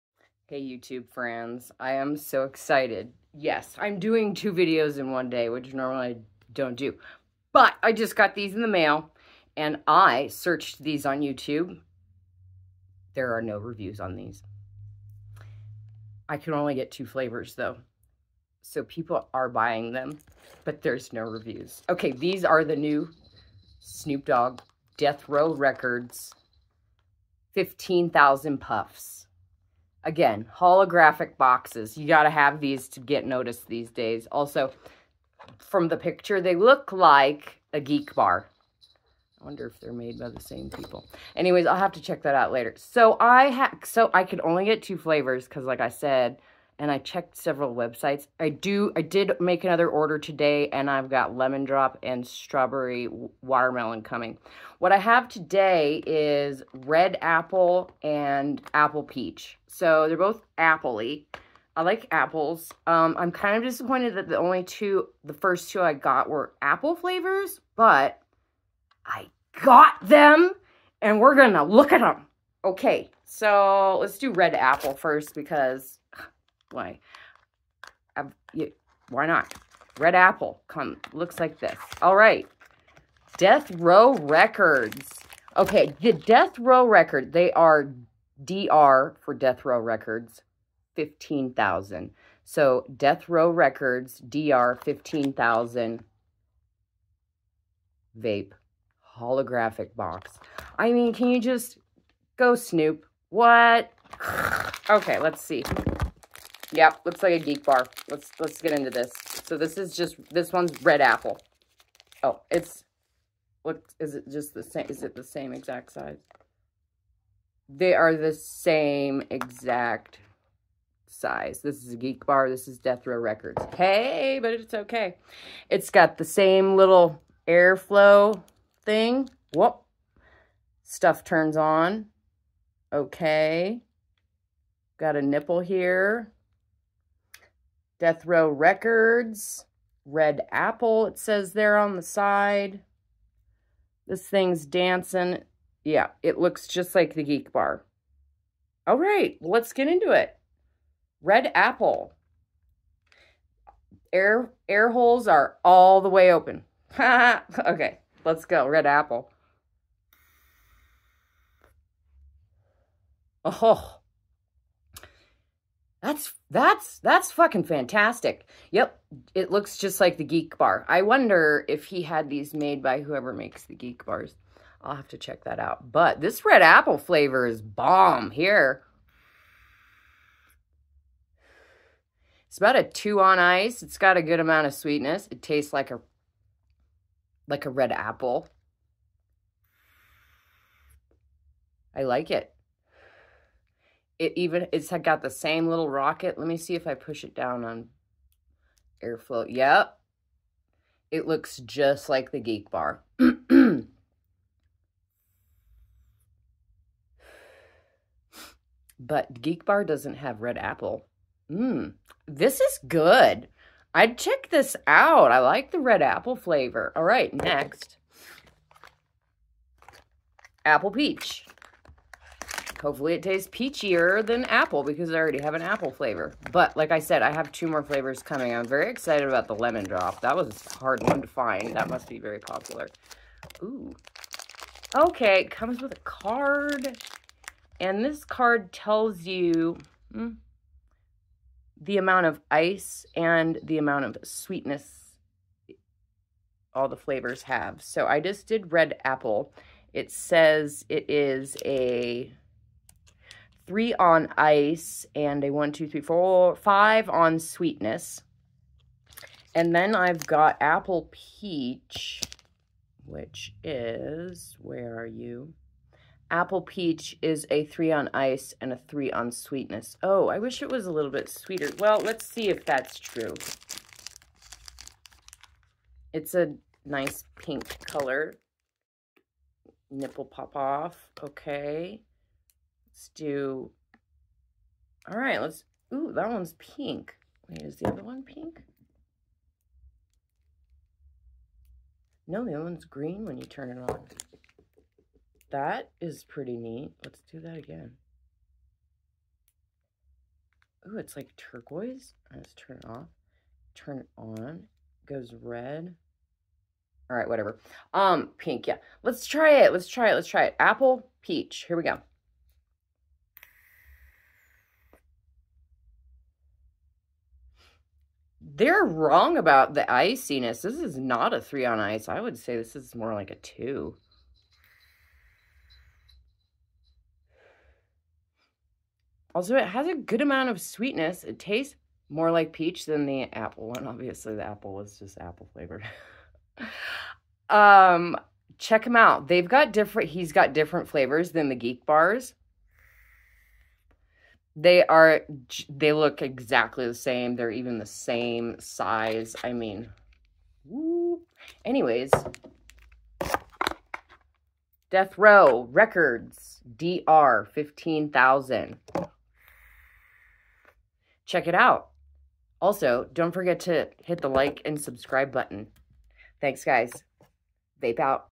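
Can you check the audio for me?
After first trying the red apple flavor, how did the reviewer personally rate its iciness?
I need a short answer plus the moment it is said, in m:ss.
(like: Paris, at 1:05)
2, at 3:02.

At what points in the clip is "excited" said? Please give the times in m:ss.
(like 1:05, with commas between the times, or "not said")
0:02, 3:48.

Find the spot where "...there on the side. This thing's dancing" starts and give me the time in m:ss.
2:21.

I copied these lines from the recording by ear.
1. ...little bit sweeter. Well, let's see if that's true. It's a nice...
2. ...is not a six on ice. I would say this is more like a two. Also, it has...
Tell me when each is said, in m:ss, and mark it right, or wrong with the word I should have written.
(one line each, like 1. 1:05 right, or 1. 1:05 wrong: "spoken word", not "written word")
1. 4:30 right
2. 5:20 wrong: "three", not "six".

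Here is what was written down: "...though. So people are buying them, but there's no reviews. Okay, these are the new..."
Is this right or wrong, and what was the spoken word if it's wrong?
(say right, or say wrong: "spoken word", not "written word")
right.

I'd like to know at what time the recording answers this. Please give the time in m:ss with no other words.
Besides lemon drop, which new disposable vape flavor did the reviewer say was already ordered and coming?
0:52.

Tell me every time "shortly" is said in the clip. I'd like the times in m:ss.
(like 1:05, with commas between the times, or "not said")
not said.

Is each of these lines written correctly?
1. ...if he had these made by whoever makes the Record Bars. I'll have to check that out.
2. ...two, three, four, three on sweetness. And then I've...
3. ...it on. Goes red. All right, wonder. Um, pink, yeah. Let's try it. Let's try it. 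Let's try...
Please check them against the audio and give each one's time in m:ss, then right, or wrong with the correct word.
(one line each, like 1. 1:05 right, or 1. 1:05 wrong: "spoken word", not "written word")
1. 2:51 wrong: "Geek", not "Record"
2. 4:15 wrong: "five", not "three"
3. 5:03 wrong: "whatever", not "wonder".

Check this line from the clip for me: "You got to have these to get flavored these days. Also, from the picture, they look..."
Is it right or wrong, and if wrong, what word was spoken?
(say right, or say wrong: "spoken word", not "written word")
wrong: "noticed", not "flavored".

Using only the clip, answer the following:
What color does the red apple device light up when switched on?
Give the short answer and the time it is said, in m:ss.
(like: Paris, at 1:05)
Green, at 4:52.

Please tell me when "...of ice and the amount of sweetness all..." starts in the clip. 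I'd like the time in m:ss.
4:02.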